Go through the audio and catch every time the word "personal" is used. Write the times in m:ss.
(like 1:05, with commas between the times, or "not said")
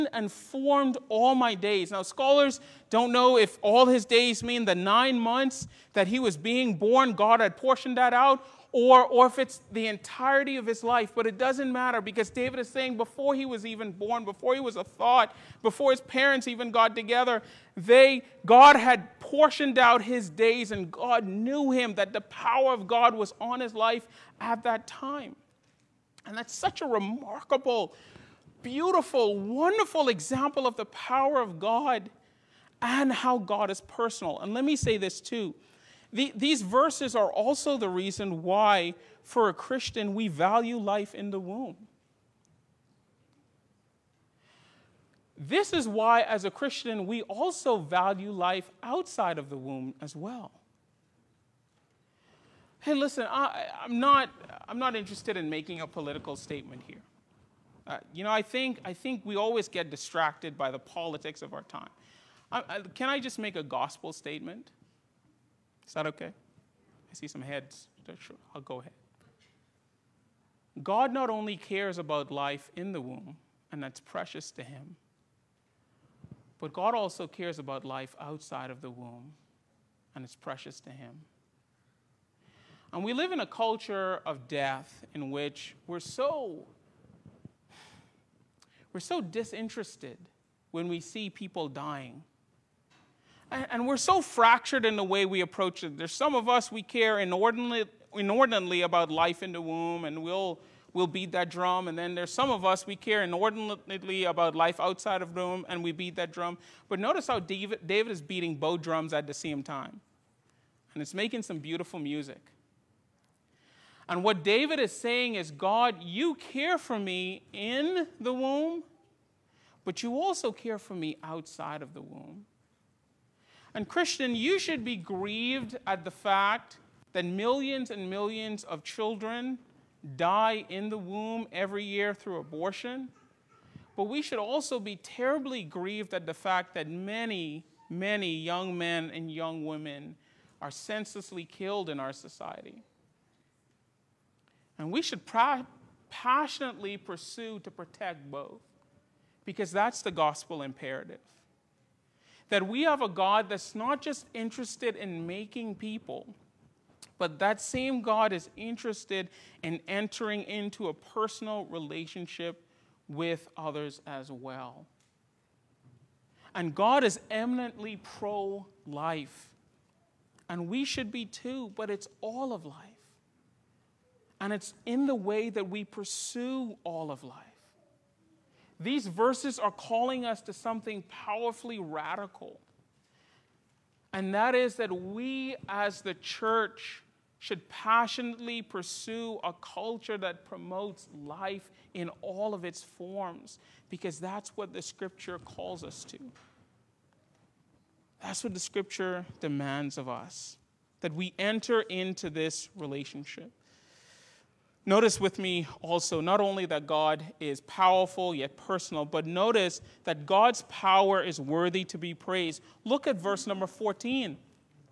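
0:33, 2:40, 3:28.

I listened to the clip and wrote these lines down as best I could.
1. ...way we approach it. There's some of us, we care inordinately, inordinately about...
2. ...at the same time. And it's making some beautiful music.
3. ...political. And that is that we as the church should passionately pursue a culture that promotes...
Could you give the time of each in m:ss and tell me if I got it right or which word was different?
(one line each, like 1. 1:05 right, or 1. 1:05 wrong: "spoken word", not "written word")
1. 1:35 right
2. 1:49 right
3. 3:01 wrong: "radical", not "political".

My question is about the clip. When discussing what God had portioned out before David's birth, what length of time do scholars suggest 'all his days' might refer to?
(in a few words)
9 months.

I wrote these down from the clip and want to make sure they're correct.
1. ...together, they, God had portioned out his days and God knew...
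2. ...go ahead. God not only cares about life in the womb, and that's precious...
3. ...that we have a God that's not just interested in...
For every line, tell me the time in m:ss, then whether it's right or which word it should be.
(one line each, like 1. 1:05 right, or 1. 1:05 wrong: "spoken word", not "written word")
1. 0:16 right
2. 1:08 right
3. 2:32 right.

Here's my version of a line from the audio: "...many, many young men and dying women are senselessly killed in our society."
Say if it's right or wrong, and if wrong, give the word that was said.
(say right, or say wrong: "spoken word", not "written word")
wrong: "young", not "dying".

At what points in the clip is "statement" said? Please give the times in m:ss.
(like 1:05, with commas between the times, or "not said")
0:56, 1:04.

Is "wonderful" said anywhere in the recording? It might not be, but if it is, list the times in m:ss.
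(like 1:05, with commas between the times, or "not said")
0:29.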